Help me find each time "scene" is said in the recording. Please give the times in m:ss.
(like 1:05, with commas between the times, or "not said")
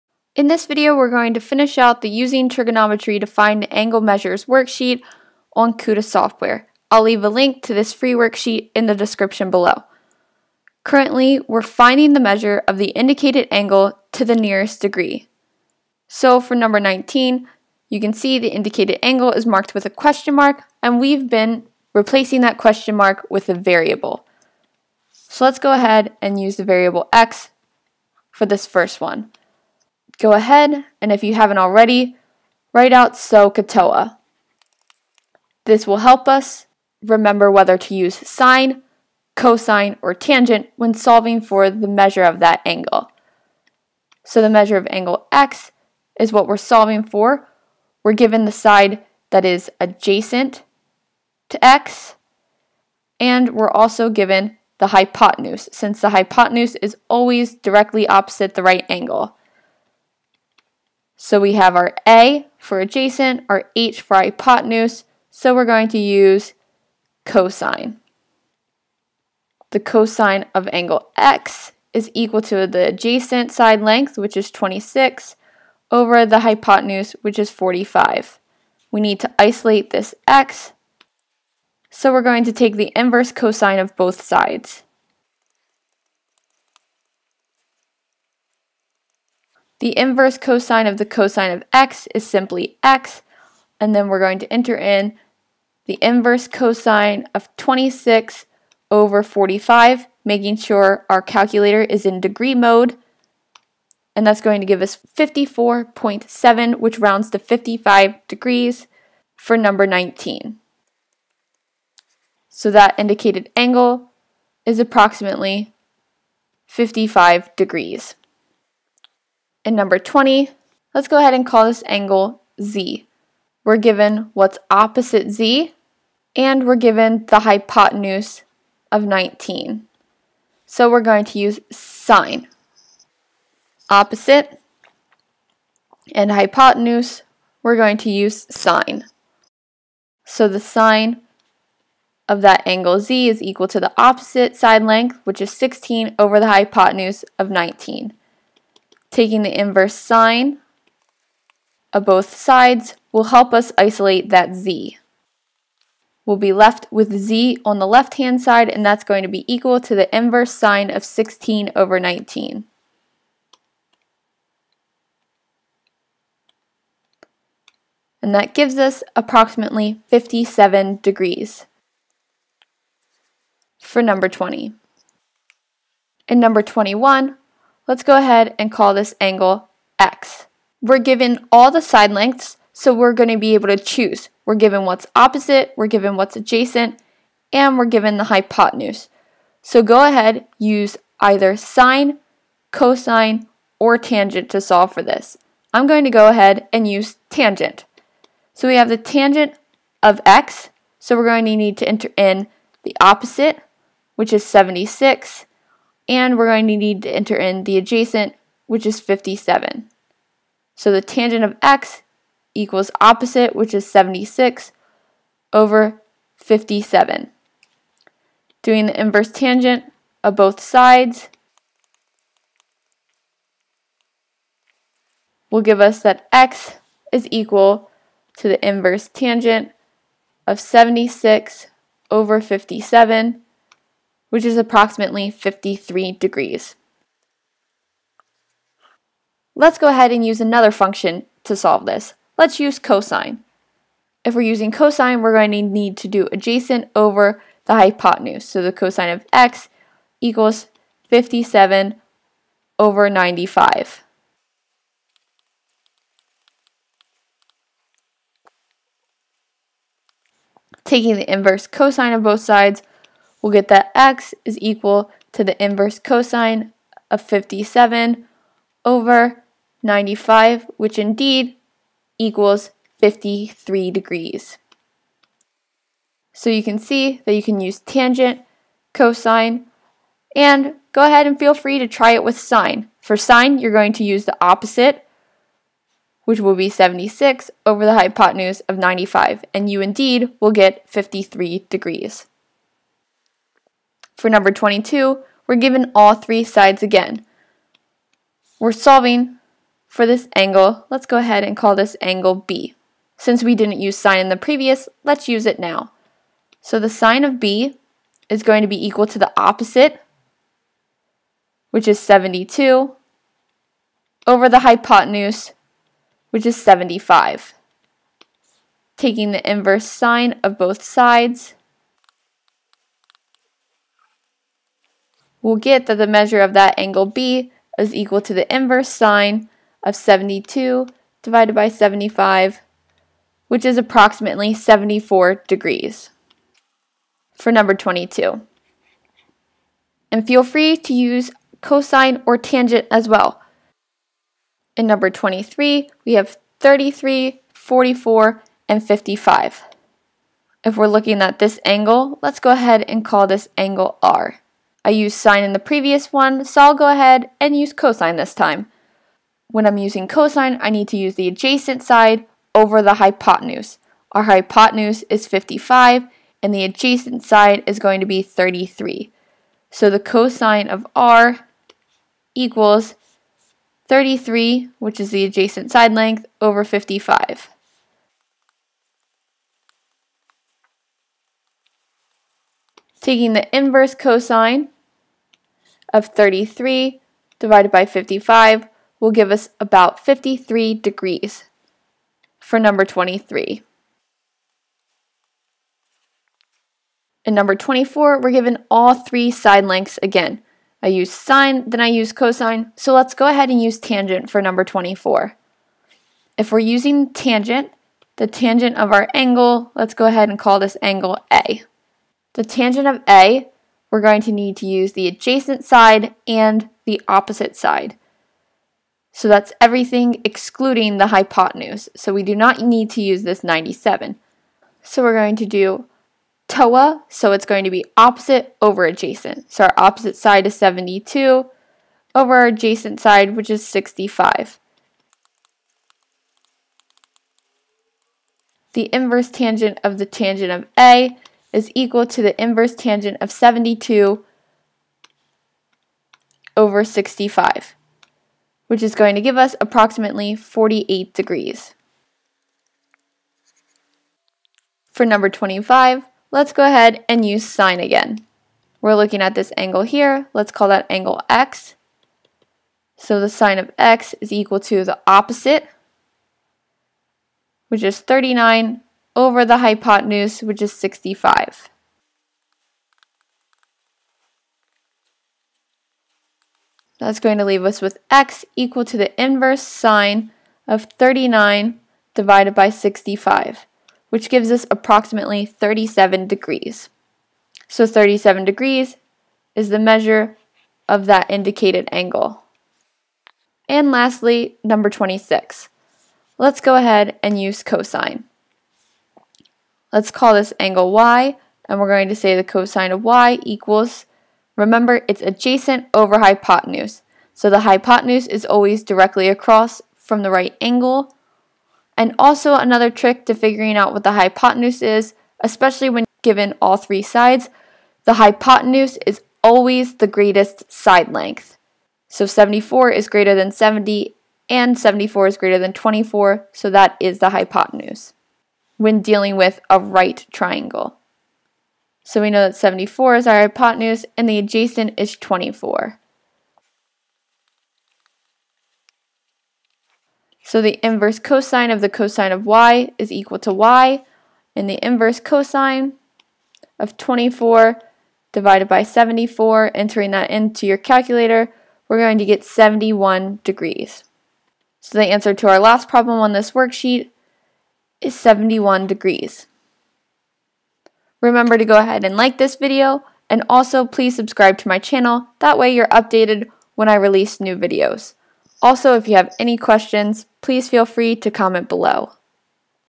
not said.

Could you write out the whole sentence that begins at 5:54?
I used sine in the previous one, so I'll go ahead and use cosine this time.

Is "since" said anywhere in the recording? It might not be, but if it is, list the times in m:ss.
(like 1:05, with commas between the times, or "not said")
0:55, 5:03.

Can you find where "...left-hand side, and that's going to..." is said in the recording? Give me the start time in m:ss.
2:37.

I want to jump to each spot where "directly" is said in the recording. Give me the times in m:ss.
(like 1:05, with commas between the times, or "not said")
0:57, 8:28.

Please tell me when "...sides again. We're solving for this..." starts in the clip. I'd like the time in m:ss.
4:56.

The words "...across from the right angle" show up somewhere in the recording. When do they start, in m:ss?
8:29.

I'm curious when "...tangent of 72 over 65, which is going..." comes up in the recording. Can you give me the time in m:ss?
7:22.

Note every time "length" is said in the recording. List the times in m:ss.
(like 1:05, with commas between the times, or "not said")
1:13, 2:24, 3:02, 6:15, 6:39, 8:41.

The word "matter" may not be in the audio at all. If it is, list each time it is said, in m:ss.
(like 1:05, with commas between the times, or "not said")
not said.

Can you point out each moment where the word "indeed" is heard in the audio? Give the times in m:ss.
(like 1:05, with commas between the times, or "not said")
4:30, 4:49.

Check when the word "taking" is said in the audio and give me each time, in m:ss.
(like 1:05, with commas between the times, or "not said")
2:29, 4:20, 5:18, 6:23.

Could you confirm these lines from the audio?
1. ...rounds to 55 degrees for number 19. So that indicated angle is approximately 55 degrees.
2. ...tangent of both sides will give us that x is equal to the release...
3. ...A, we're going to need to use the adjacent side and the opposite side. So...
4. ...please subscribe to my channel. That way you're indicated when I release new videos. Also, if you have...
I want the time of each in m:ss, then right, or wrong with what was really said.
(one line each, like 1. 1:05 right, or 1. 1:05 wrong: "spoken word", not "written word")
1. 1:46 right
2. 3:39 wrong: "inverse", not "release"
3. 6:53 right
4. 9:23 wrong: "updated", not "indicated".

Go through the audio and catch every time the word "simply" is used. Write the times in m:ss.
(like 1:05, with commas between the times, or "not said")
1:32.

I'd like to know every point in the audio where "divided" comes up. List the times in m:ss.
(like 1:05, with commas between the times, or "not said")
5:31, 6:27, 8:02, 9:08.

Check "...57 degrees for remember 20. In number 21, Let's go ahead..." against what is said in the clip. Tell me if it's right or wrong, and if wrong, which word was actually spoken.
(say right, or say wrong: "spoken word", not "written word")
wrong: "number", not "remember".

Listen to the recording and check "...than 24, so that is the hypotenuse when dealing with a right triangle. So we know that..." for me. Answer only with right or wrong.
right.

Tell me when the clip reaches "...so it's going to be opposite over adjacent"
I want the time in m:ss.
7:07.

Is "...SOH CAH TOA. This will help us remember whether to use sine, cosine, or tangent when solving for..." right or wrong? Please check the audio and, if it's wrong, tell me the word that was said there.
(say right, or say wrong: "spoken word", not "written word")
right.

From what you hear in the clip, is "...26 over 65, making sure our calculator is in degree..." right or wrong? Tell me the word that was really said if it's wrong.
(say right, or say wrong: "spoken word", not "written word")
wrong: "45", not "65".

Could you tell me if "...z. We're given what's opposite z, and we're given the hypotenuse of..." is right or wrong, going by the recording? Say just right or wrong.
right.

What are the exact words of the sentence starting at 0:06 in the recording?
I'll leave a link to this free worksheet in the description below.